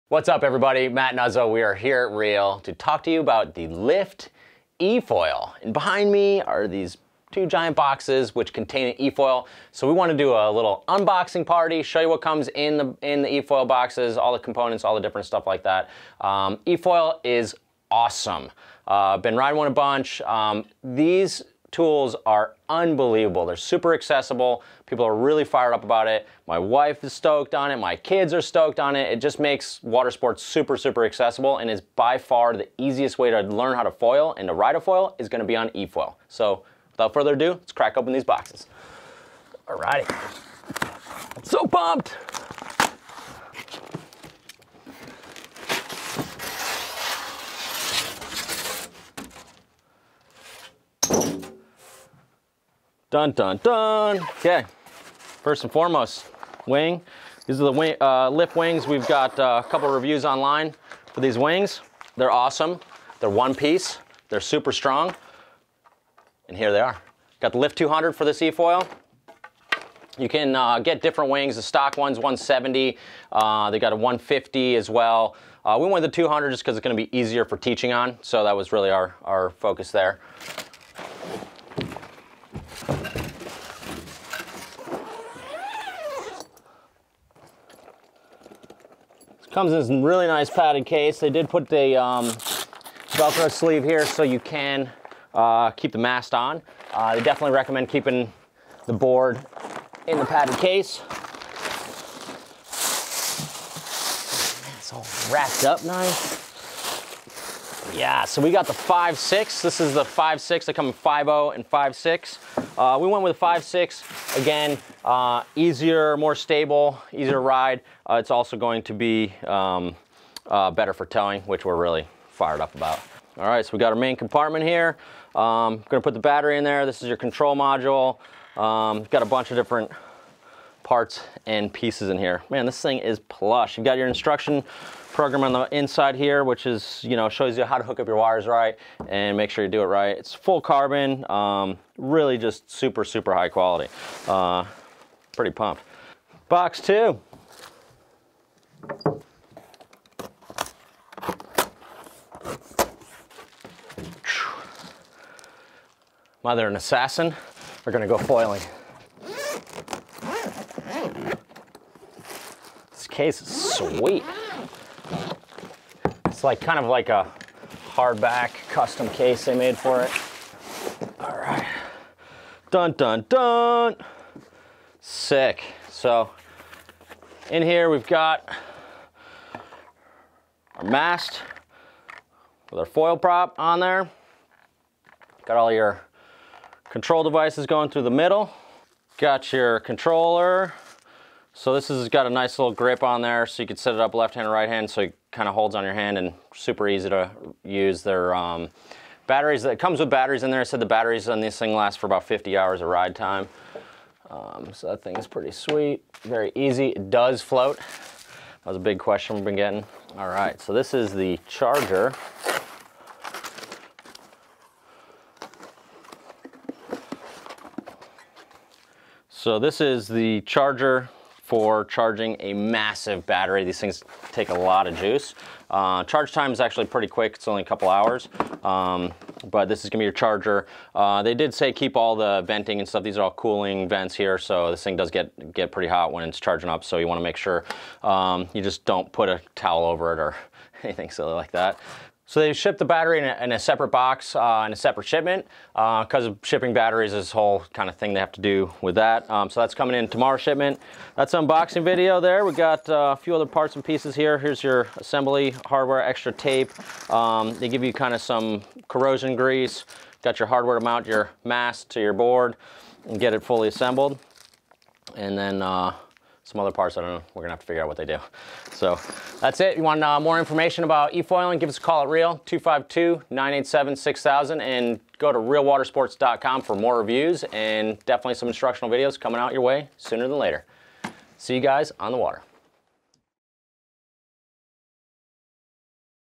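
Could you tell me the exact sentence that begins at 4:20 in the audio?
Got your hardware to mount your mast to your board and get it fully assembled.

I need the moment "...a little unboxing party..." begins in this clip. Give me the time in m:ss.
0:10.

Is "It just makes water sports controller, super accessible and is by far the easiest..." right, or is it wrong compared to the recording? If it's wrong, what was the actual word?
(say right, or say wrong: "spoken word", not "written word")
wrong: "super", not "controller".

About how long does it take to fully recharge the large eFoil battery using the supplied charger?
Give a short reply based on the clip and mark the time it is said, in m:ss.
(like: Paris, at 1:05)
A couple hours, at 3:47.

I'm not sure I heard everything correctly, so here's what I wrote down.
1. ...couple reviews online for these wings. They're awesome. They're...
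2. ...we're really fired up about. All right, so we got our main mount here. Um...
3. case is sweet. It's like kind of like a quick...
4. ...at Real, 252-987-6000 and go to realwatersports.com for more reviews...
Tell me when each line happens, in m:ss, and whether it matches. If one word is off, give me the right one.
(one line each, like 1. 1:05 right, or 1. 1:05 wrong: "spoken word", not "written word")
1. 0:59 right
2. 2:01 wrong: "compartment", not "mount"
3. 2:43 wrong: "hardback", not "quick"
4. 4:32 right.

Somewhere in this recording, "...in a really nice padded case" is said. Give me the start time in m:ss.
1:29.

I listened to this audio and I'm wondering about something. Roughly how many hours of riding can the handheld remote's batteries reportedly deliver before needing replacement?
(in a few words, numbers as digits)
50 hours.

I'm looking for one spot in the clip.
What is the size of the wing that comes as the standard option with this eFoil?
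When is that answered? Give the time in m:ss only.
1:11.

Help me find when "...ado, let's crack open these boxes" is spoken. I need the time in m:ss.
0:37.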